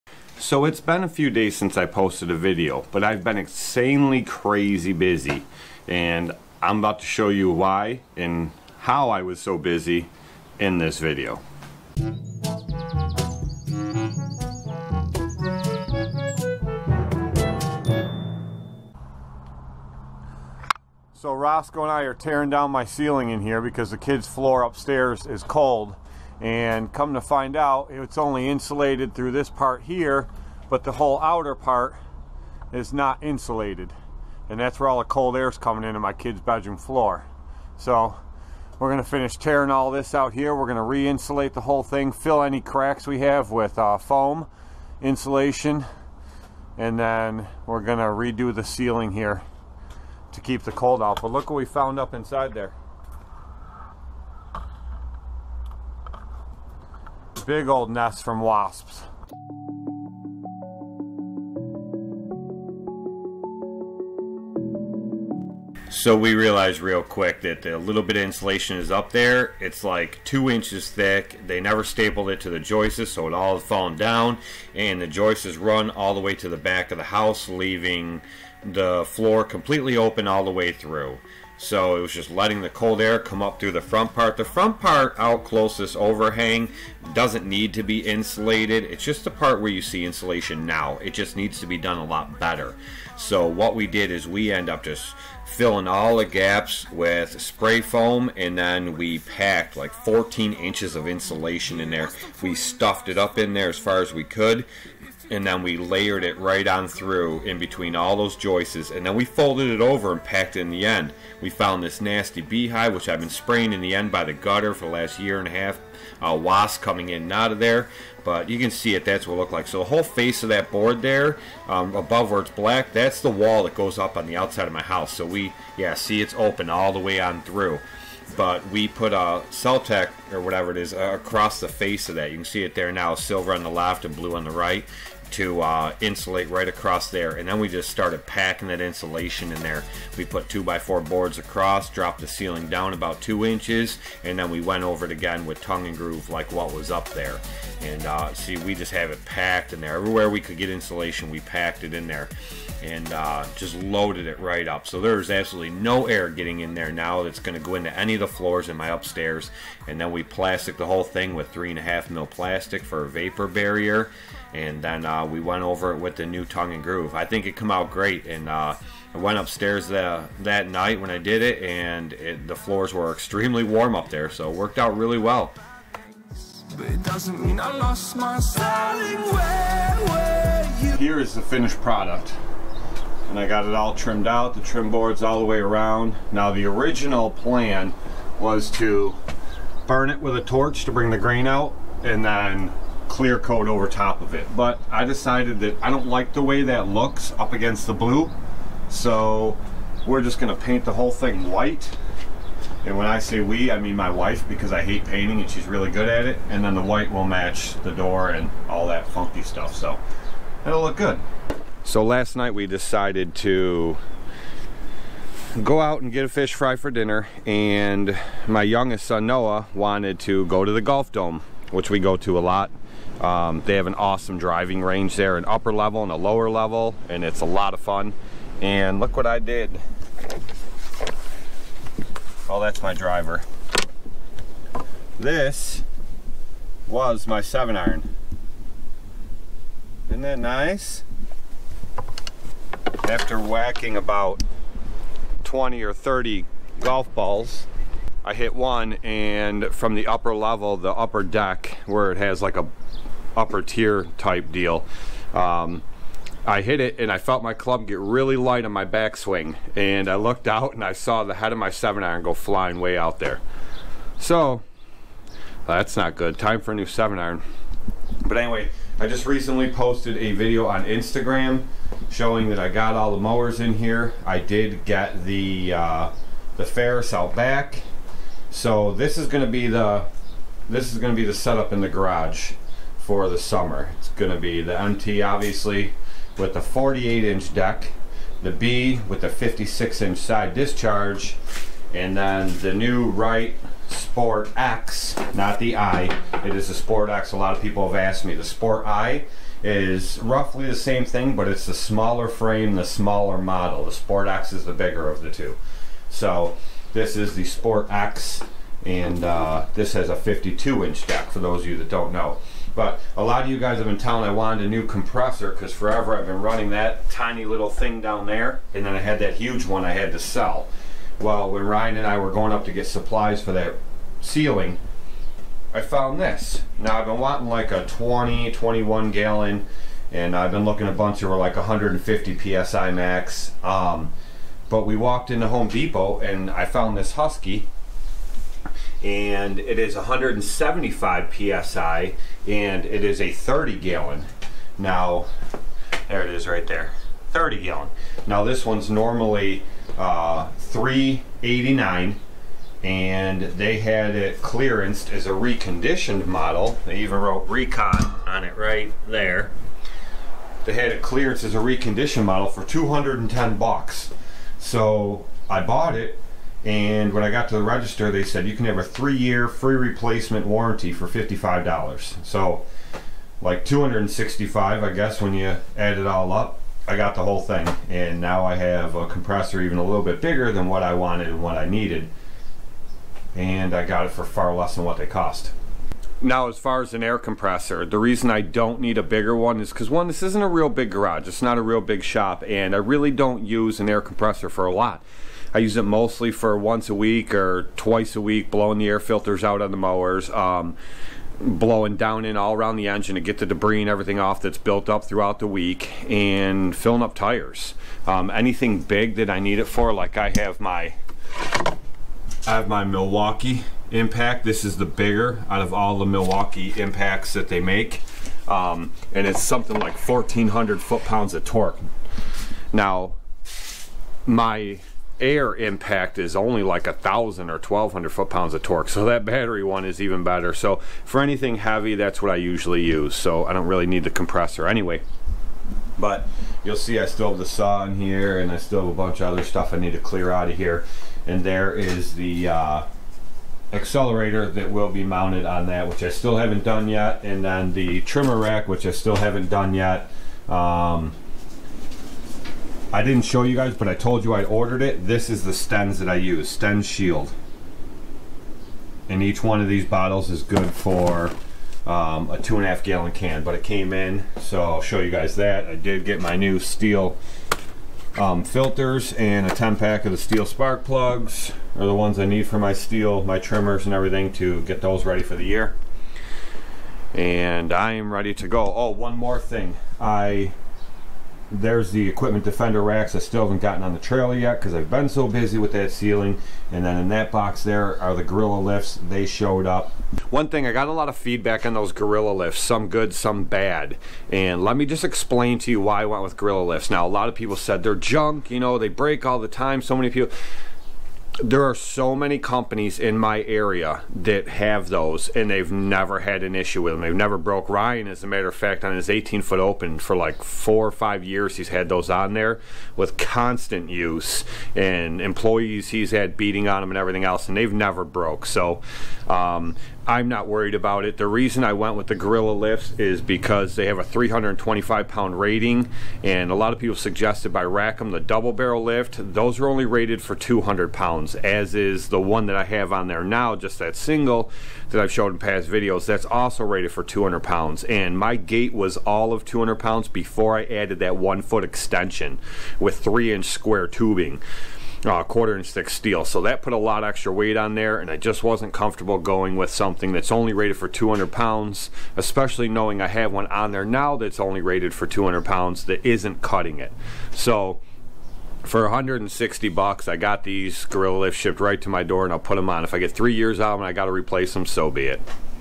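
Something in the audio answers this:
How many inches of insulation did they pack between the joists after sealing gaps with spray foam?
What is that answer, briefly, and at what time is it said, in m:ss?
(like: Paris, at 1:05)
14, at 1:39.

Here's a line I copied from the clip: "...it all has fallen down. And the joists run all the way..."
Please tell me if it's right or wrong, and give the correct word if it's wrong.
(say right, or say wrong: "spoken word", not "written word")
right.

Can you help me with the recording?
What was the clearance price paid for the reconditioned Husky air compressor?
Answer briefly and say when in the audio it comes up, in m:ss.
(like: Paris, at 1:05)
$210, at 6:02.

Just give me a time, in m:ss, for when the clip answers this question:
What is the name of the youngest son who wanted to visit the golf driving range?
3:39.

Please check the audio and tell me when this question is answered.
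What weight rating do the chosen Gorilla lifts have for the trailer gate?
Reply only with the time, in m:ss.
8:44.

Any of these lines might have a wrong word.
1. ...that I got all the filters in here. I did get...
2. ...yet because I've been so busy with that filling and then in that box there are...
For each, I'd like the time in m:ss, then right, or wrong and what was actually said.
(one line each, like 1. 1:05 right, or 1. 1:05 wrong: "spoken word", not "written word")
1. 4:32 wrong: "mowers", not "filters"
2. 8:04 wrong: "ceiling", not "filling".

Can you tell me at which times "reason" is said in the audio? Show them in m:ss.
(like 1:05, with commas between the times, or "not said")
6:27, 8:41.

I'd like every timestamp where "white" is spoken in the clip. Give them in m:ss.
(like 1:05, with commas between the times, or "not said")
3:21, 3:26.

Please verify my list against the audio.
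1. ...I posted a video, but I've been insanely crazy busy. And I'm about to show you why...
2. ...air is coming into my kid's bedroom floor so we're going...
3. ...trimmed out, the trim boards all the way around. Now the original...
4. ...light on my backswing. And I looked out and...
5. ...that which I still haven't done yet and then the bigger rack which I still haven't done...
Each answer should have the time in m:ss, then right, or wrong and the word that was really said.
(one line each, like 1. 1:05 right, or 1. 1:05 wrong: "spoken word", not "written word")
1. 0:01 right
2. 0:35 right
3. 3:03 right
4. 4:18 right
5. 7:25 wrong: "trimmer", not "bigger".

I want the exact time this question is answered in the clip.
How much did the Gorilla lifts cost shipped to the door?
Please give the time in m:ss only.
9:18.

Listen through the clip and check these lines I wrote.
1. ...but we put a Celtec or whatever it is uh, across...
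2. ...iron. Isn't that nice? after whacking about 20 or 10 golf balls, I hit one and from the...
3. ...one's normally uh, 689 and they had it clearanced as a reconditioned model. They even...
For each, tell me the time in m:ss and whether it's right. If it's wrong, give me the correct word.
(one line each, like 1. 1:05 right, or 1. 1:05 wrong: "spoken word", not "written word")
1. 2:08 right
2. 3:57 wrong: "30", not "10"
3. 5:48 wrong: "389", not "689".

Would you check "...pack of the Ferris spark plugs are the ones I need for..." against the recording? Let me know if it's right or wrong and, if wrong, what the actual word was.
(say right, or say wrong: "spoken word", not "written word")
wrong: "Stihl", not "Ferris".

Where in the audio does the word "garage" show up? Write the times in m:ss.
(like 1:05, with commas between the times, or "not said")
4:41, 6:30.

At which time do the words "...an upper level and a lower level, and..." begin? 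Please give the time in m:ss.
3:45.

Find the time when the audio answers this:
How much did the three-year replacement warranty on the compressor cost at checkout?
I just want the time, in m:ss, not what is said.
6:11.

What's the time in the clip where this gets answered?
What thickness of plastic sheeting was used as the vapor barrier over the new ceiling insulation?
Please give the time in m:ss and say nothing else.
2:41.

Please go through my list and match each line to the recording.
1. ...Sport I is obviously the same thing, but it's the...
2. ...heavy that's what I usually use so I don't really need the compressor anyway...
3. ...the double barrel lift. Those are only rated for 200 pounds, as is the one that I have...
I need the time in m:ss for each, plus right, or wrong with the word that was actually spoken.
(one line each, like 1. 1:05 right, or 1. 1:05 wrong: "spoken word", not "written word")
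1. 4:58 wrong: "roughly", not "obviously"
2. 7:11 right
3. 8:48 right.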